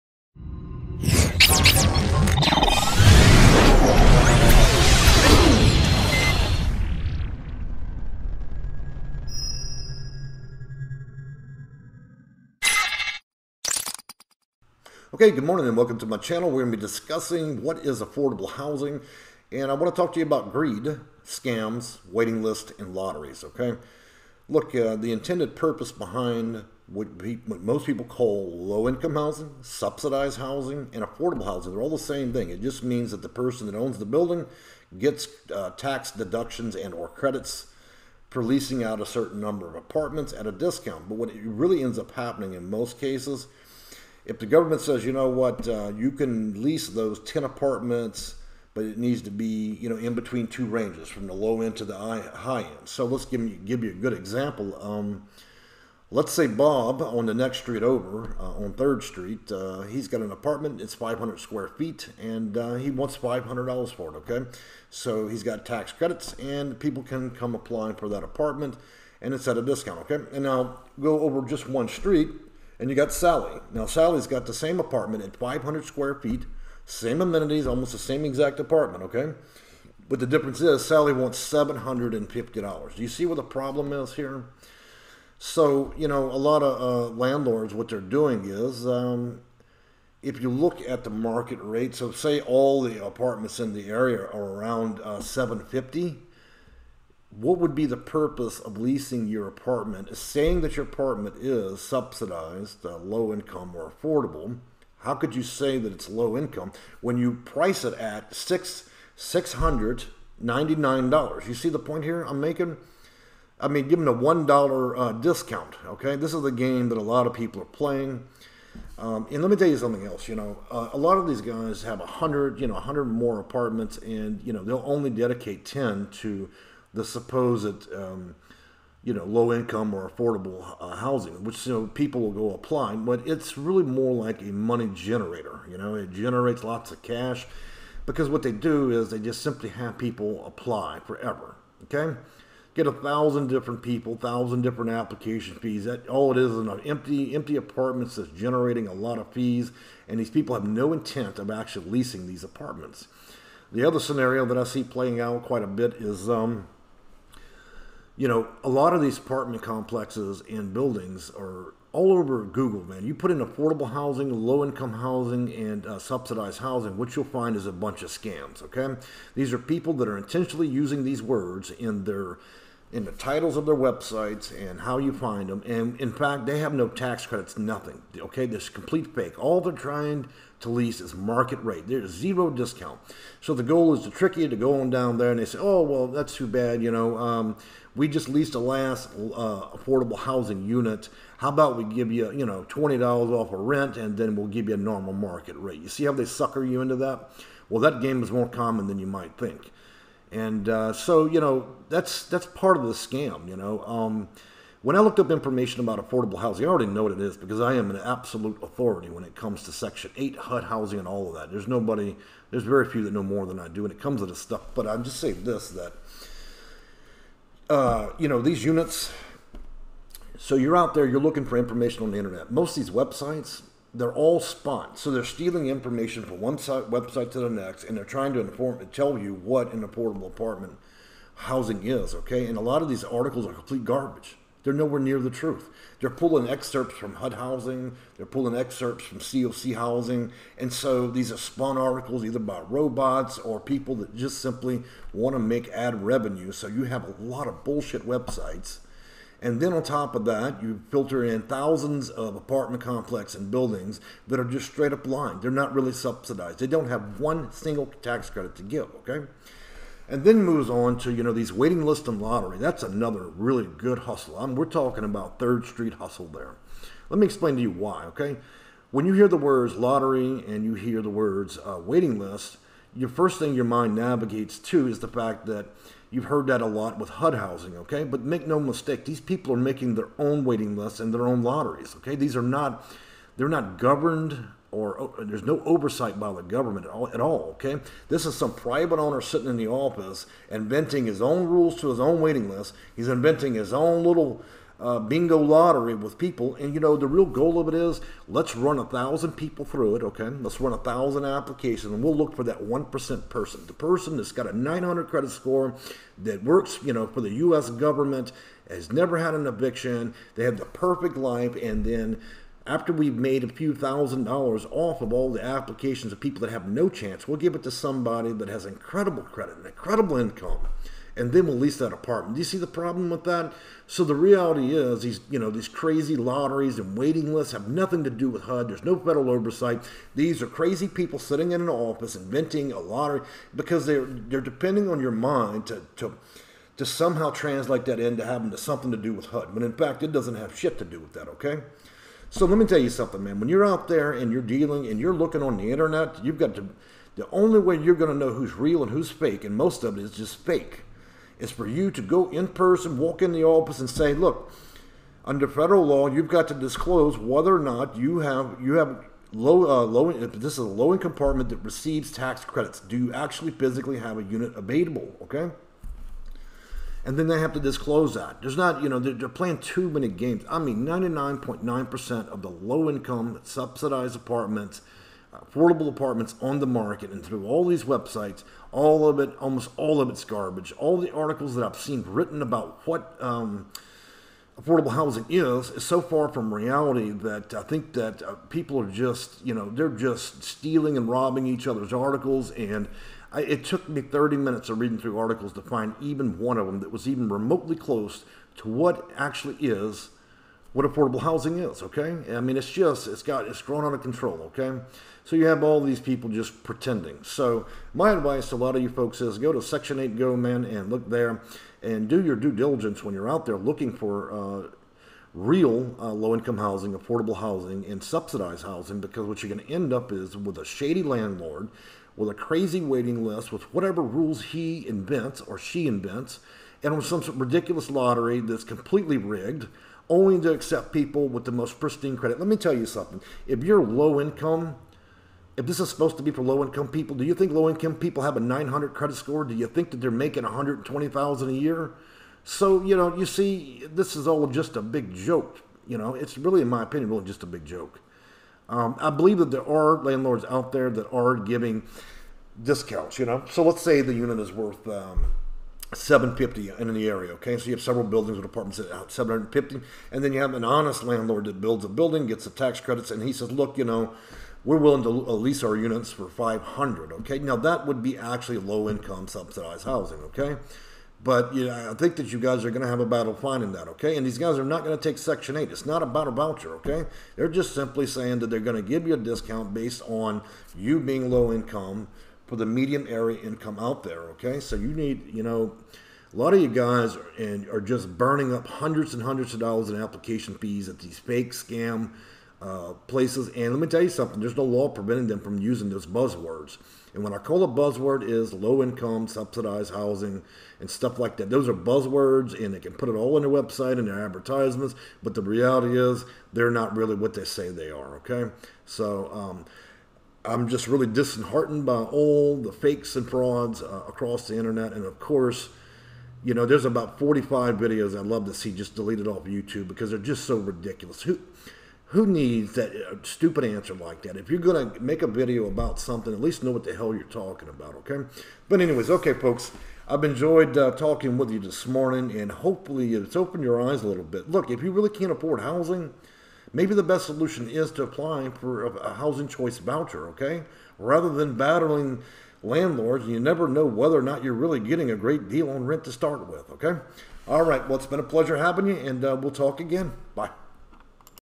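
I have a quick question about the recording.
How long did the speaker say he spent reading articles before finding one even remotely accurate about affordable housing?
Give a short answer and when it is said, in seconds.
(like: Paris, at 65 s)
30 minutes, at 394 s.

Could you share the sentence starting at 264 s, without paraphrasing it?
I'm, we're talking about Third Street hustle there.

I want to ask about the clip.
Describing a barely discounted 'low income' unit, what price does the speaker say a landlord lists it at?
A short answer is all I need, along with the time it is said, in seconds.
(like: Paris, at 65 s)
$699, at 109 s.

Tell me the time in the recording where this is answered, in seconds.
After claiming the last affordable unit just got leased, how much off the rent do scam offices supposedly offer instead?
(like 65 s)
192 s.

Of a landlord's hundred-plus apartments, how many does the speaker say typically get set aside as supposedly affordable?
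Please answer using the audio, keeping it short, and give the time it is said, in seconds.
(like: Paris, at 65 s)
10, at 125 s.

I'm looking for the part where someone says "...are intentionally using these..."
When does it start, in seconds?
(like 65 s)
170 s.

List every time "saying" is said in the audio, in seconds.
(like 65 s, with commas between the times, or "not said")
100 s, 215 s, 478 s.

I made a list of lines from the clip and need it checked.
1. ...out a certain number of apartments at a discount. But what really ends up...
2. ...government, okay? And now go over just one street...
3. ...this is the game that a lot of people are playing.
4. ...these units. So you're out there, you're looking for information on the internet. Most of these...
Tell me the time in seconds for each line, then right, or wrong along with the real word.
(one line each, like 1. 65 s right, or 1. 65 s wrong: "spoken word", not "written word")
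1. 38 s right
2. 69 s wrong: "discount", not "government"
3. 116 s right
4. 218 s right.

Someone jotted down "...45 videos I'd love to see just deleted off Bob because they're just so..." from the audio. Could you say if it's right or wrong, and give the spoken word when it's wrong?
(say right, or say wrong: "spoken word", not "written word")
wrong: "YouTube", not "Bob".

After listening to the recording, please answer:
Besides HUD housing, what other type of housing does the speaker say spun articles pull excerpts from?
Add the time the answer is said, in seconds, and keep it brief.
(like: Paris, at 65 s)
COC housing, at 239 s.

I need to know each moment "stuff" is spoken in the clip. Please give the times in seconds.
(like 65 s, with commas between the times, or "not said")
214 s, 500 s.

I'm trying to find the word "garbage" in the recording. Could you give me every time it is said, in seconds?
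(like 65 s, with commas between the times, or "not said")
233 s, 380 s.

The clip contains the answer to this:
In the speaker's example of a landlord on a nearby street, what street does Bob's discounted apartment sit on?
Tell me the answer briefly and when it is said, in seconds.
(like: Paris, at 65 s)
3rd Street, at 58 s.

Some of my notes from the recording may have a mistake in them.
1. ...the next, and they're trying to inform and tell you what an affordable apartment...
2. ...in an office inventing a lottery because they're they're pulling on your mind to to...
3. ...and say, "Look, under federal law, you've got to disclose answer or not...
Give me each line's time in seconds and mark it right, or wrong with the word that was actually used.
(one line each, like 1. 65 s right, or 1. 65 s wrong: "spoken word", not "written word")
1. 227 s right
2. 331 s wrong: "depending", not "pulling"
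3. 353 s wrong: "whether", not "answer".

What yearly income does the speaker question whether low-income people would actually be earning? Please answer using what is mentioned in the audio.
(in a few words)
$120,000.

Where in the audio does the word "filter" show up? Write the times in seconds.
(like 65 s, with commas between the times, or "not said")
250 s.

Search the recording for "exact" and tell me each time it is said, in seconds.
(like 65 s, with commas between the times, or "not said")
78 s.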